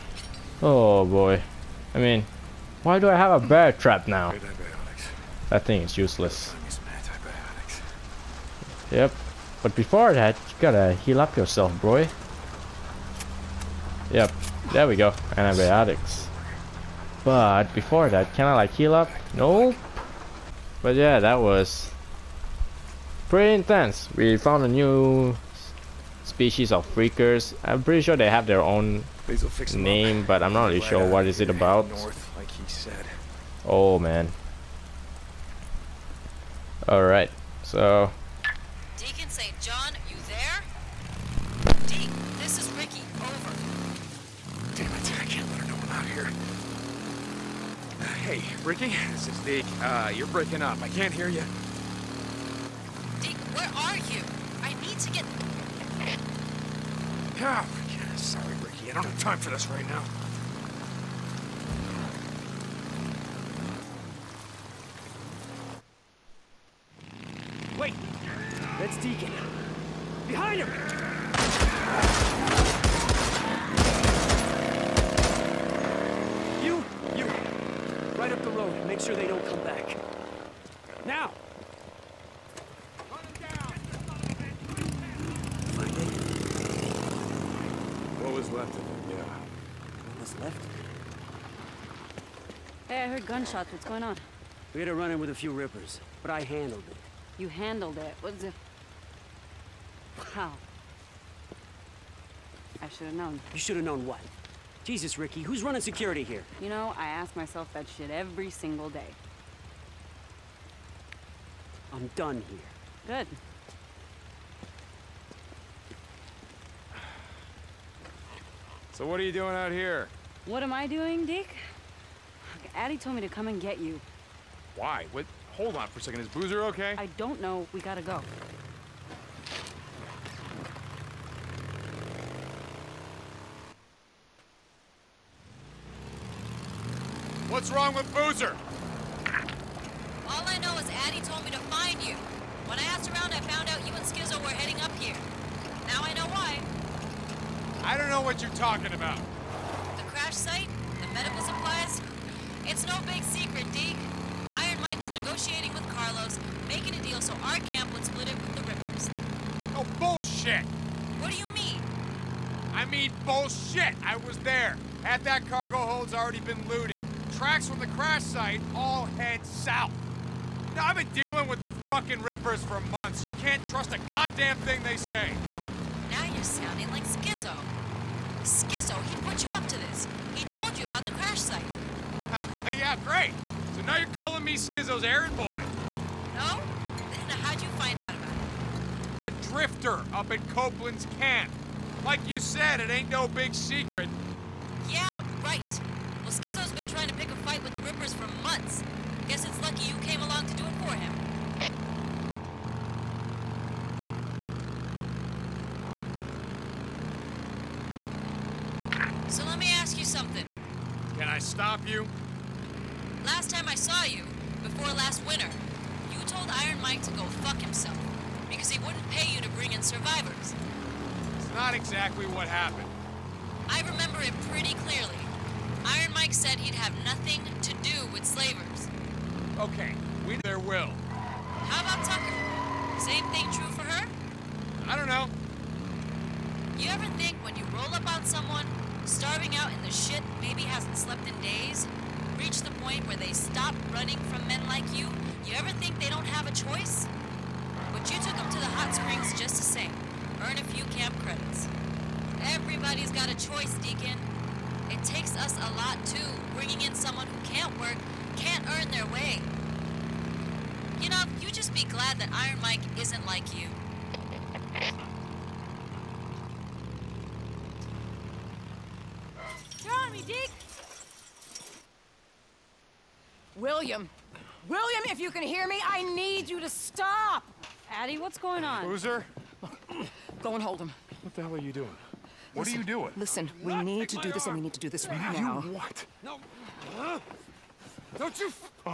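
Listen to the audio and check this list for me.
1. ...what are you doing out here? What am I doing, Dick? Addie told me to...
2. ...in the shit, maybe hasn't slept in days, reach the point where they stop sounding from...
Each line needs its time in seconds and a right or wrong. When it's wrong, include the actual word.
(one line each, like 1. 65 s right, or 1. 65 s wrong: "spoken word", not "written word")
1. 119 s right
2. 239 s wrong: "running", not "sounding".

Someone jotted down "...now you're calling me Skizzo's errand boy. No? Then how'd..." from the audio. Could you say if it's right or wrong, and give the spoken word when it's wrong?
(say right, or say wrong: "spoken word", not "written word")
right.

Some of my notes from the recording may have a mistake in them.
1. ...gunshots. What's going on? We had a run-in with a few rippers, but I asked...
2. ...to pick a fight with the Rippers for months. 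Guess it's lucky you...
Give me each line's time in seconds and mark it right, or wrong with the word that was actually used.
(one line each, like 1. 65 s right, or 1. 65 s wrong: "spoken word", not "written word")
1. 93 s wrong: "handled", not "asked"
2. 197 s right.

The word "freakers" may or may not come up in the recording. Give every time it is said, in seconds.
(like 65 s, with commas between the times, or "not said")
26 s.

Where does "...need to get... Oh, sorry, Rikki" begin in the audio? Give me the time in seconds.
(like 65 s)
54 s.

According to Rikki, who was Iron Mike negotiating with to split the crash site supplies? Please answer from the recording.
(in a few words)
Carlos.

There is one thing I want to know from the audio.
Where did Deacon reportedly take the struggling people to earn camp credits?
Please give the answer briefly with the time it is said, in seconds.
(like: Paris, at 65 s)
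The hot springs, at 248 s.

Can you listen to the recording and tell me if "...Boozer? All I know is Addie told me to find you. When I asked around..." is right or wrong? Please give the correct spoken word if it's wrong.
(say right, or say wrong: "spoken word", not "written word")
right.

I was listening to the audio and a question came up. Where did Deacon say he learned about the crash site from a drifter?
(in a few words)
Copeland's camp.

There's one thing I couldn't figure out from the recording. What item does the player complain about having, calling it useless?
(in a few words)
Bear trap.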